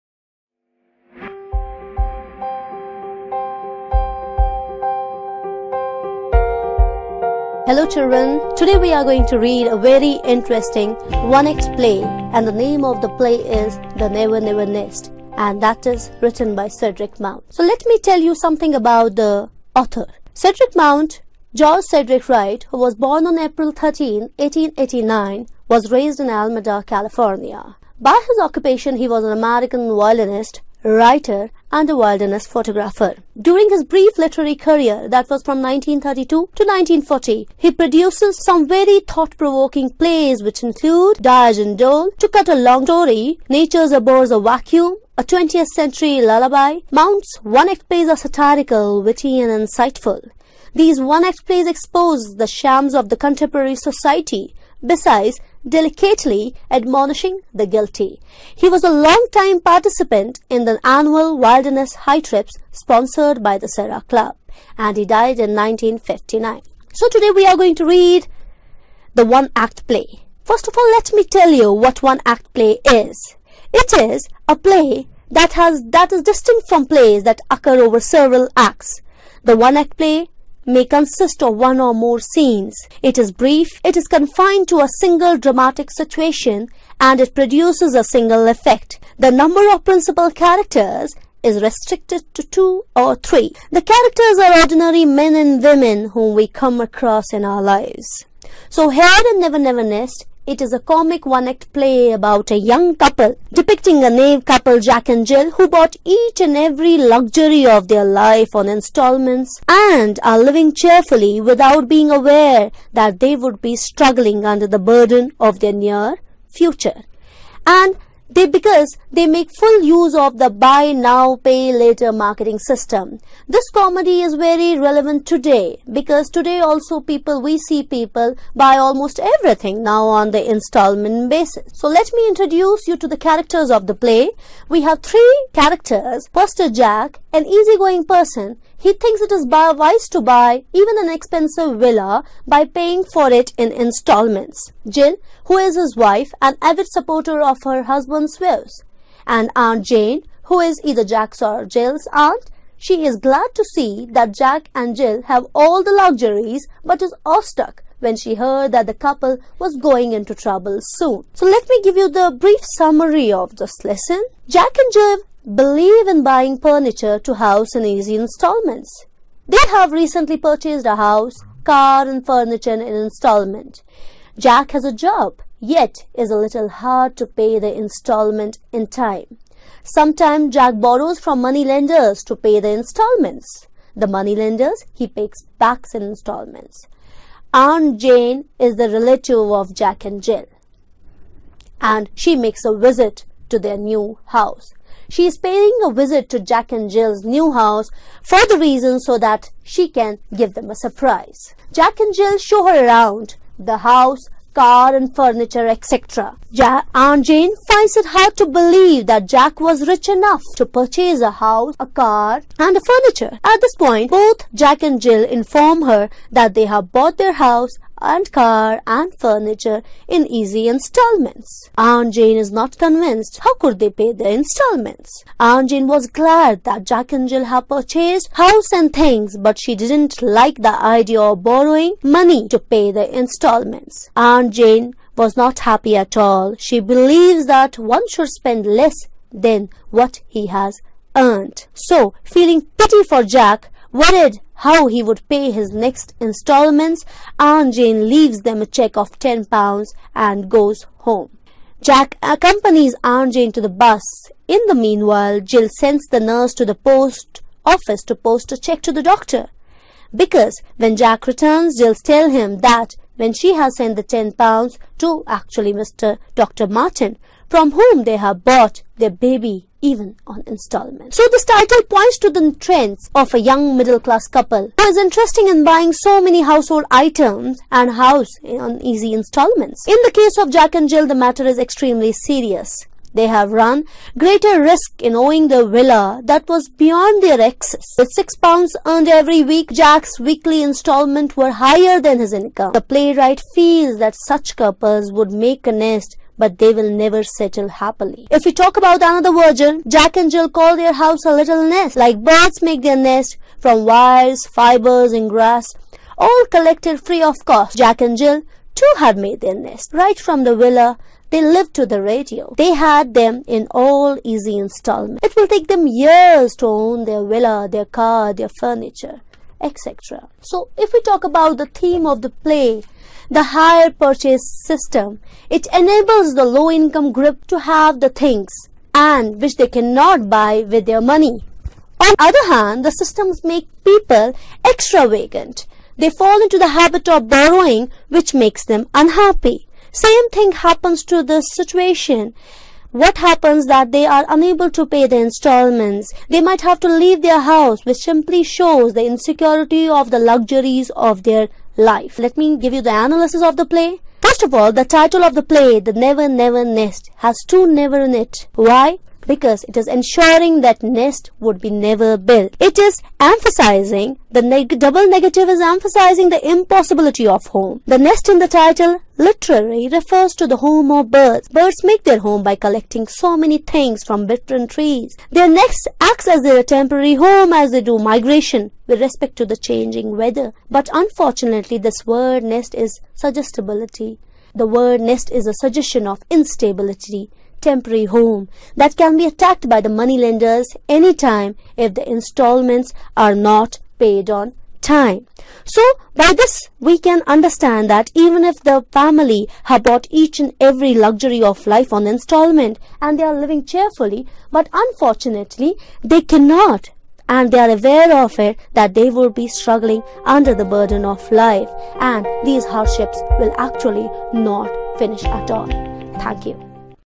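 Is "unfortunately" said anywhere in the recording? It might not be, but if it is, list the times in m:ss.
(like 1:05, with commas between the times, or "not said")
6:20, 6:44.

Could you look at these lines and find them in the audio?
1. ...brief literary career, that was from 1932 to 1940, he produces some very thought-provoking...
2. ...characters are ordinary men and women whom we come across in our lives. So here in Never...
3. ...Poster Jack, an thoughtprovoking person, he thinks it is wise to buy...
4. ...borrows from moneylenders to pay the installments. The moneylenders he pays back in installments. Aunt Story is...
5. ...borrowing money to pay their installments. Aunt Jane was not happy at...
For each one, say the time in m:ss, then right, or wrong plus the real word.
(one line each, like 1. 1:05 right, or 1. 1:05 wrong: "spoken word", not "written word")
1. 0:33 right
2. 1:33 right
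3. 2:16 wrong: "easygoing", not "thoughtprovoking"
4. 3:00 wrong: "Jane", not "Story"
5. 3:51 right.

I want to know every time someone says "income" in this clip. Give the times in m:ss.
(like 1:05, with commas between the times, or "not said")
4:52, 5:26.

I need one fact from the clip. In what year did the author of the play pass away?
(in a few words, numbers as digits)
1959.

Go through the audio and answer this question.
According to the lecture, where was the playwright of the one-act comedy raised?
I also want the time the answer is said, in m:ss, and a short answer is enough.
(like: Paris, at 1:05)
Alameda, California, at 0:26.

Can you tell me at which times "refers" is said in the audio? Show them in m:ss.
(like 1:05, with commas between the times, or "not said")
6:09.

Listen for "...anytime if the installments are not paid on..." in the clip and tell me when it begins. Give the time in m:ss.
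6:30.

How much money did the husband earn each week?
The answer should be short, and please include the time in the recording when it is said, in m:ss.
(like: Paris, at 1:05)
6 pounds, at 4:48.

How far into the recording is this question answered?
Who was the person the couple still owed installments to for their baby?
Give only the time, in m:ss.
4:26.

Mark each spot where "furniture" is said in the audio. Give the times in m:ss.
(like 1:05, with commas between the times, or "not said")
2:46, 2:52, 3:25, 3:32, 3:39, 5:18.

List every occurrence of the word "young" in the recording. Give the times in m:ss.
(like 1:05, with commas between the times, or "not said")
1:42, 4:33.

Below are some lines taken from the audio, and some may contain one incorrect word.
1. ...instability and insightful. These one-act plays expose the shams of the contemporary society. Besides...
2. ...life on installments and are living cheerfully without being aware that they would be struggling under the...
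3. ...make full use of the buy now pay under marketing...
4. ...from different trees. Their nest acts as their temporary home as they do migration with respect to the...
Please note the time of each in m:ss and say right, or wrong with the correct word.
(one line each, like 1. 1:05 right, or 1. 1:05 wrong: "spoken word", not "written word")
1. 0:49 wrong: "witty", not "instability"
2. 1:48 right
3. 1:59 wrong: "later", not "under"
4. 6:14 right.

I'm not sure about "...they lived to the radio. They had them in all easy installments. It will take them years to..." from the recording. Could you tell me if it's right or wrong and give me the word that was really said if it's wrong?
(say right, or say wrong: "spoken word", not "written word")
right.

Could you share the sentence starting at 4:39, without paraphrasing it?
In the case of Jack and Jill, the matter is extremely serious.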